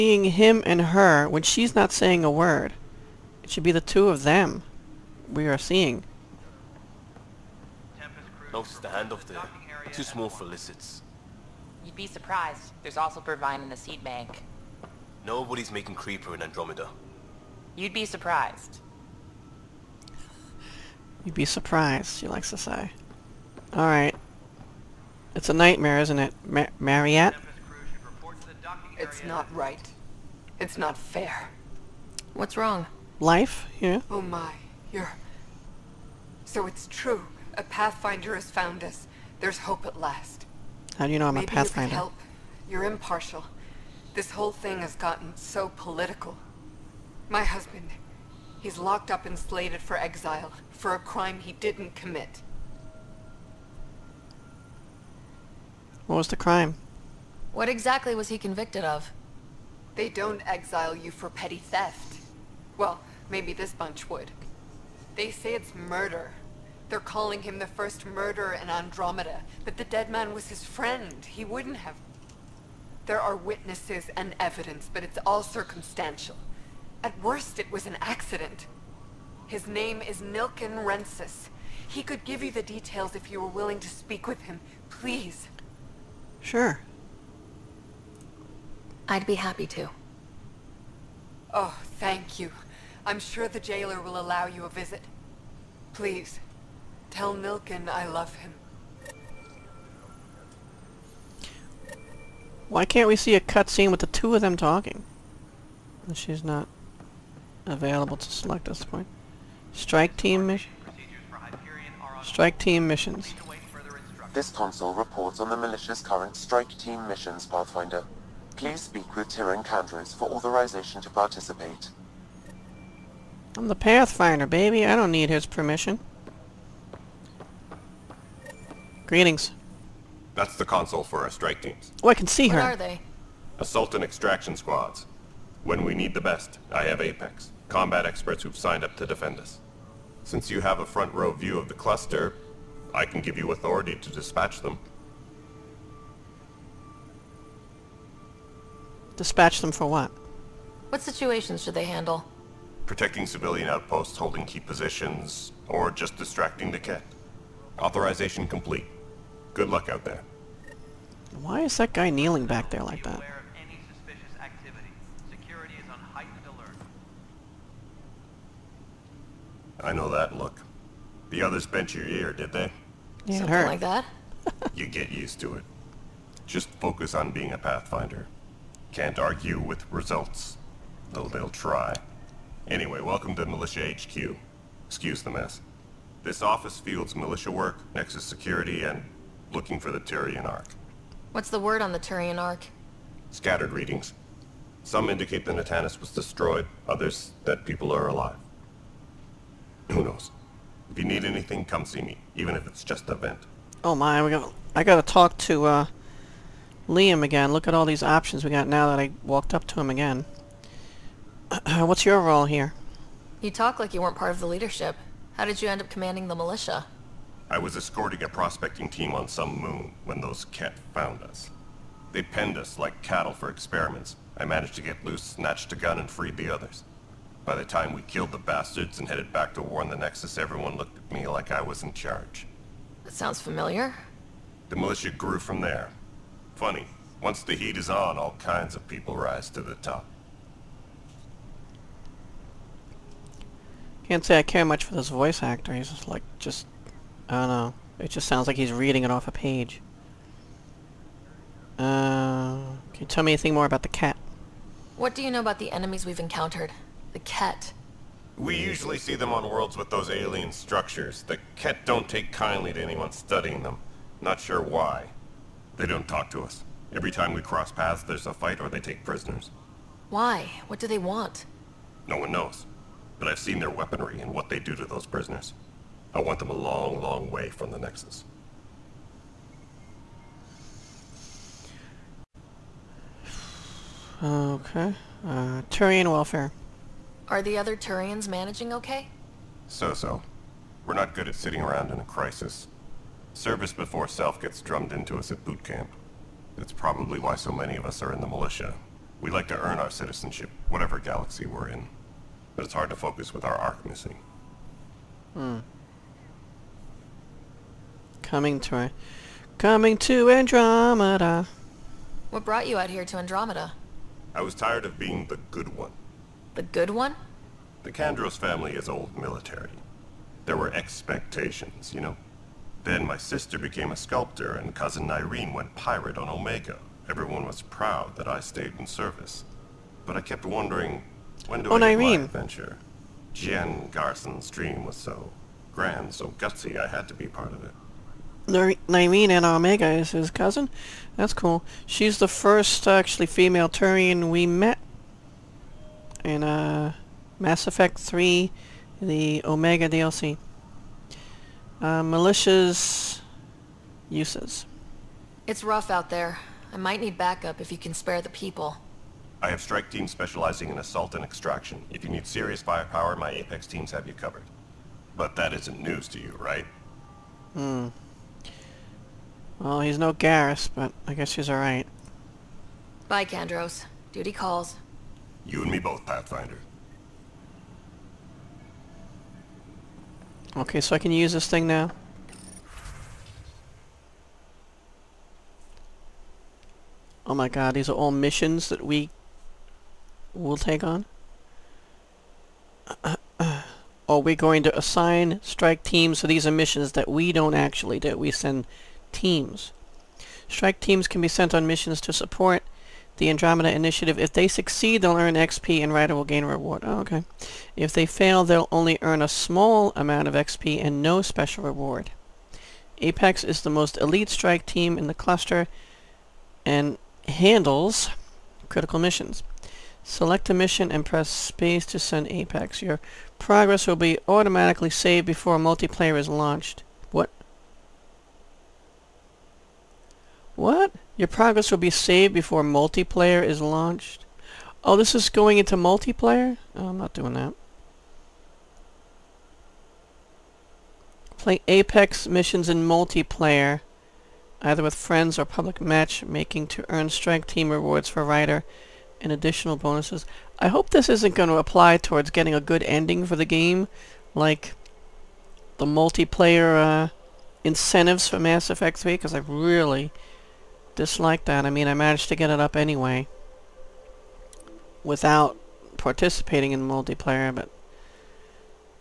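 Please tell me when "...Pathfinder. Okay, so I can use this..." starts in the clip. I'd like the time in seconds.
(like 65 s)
376 s.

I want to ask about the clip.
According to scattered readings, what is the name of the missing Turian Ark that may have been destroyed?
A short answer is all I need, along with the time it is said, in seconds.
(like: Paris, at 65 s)
Natanis, at 195 s.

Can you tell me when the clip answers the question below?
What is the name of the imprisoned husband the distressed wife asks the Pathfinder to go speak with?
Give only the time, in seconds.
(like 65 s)
80 s.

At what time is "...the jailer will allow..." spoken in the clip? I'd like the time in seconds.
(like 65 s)
93 s.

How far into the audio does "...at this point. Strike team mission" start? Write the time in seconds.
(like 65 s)
108 s.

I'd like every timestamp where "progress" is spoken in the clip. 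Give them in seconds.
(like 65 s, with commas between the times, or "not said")
423 s, 431 s.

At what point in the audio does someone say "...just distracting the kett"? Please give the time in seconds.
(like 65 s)
155 s.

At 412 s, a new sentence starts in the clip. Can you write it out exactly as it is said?
Apex is the most elite strike team in the cluster and handles critical missions.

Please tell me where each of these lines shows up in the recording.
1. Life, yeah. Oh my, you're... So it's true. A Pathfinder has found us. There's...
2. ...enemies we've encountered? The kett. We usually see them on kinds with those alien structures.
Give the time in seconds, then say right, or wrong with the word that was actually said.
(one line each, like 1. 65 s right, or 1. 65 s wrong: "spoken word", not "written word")
1. 33 s right
2. 255 s wrong: "worlds", not "kinds".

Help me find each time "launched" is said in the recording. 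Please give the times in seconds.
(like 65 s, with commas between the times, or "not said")
426 s, 433 s.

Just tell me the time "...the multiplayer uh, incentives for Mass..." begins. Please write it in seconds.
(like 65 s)
455 s.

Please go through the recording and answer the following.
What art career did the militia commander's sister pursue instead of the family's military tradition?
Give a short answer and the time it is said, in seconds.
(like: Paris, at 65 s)
sculptor, at 323 s.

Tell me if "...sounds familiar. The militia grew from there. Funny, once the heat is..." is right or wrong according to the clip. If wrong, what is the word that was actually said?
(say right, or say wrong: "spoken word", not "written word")
right.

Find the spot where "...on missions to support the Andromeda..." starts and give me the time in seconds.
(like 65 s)
401 s.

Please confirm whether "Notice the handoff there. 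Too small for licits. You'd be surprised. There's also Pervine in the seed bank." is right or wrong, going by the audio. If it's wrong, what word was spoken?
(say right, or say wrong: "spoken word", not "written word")
right.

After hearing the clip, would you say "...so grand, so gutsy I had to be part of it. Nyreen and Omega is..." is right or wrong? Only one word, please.
right.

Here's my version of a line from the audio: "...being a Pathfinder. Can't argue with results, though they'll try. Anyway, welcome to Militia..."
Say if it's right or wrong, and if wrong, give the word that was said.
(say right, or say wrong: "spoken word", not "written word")
right.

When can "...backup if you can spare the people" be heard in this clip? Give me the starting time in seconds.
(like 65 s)
357 s.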